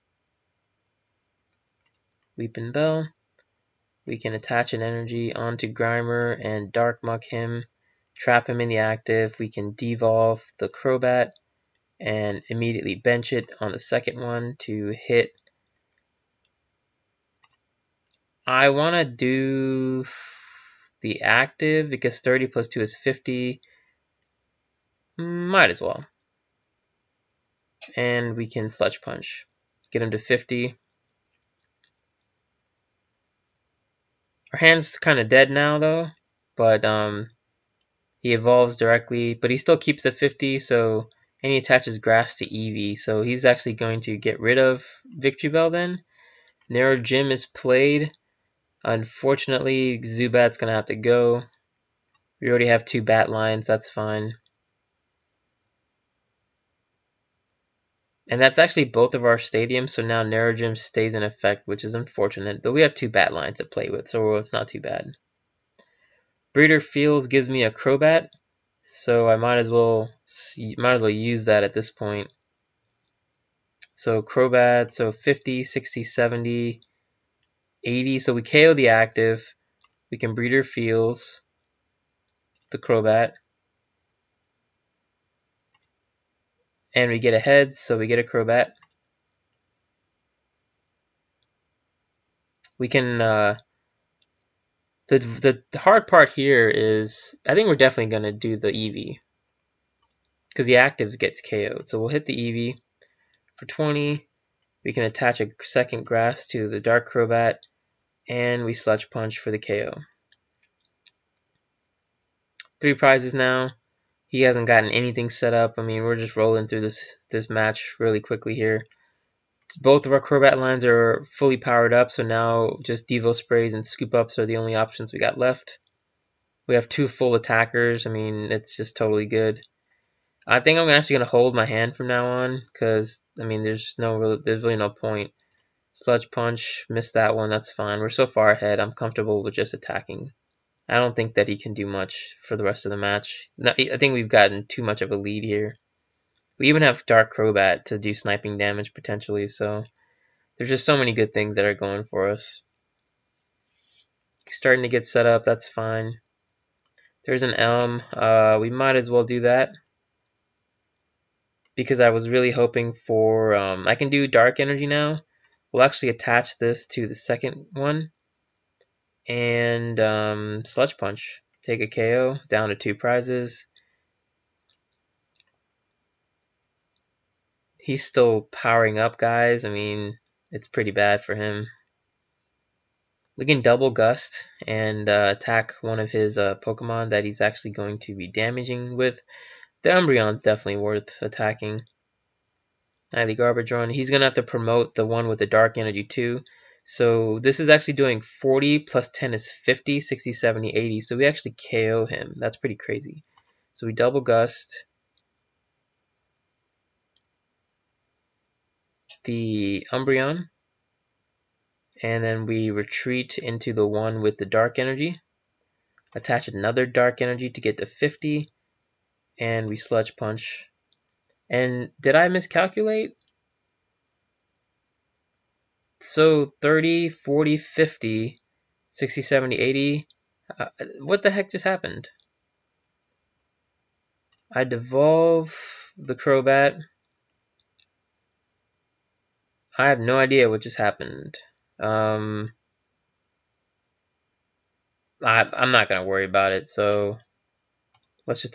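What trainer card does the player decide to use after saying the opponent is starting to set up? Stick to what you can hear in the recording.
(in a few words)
Elm.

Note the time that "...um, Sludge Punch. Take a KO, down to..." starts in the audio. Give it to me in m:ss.
2:49.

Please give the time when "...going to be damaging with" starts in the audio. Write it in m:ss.
3:07.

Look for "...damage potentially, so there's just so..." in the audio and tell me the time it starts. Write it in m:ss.
2:28.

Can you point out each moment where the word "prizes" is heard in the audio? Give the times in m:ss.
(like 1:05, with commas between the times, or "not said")
1:52, 2:52.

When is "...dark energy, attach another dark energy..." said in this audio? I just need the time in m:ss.
3:34.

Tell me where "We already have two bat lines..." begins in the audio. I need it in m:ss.
0:52.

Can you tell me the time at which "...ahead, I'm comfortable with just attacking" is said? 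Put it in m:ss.
2:18.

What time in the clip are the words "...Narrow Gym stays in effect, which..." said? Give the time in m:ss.
1:00.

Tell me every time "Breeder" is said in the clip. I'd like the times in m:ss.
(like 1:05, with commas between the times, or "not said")
1:06, 1:20.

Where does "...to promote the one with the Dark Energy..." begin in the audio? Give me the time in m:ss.
3:14.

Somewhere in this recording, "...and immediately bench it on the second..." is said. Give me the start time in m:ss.
0:11.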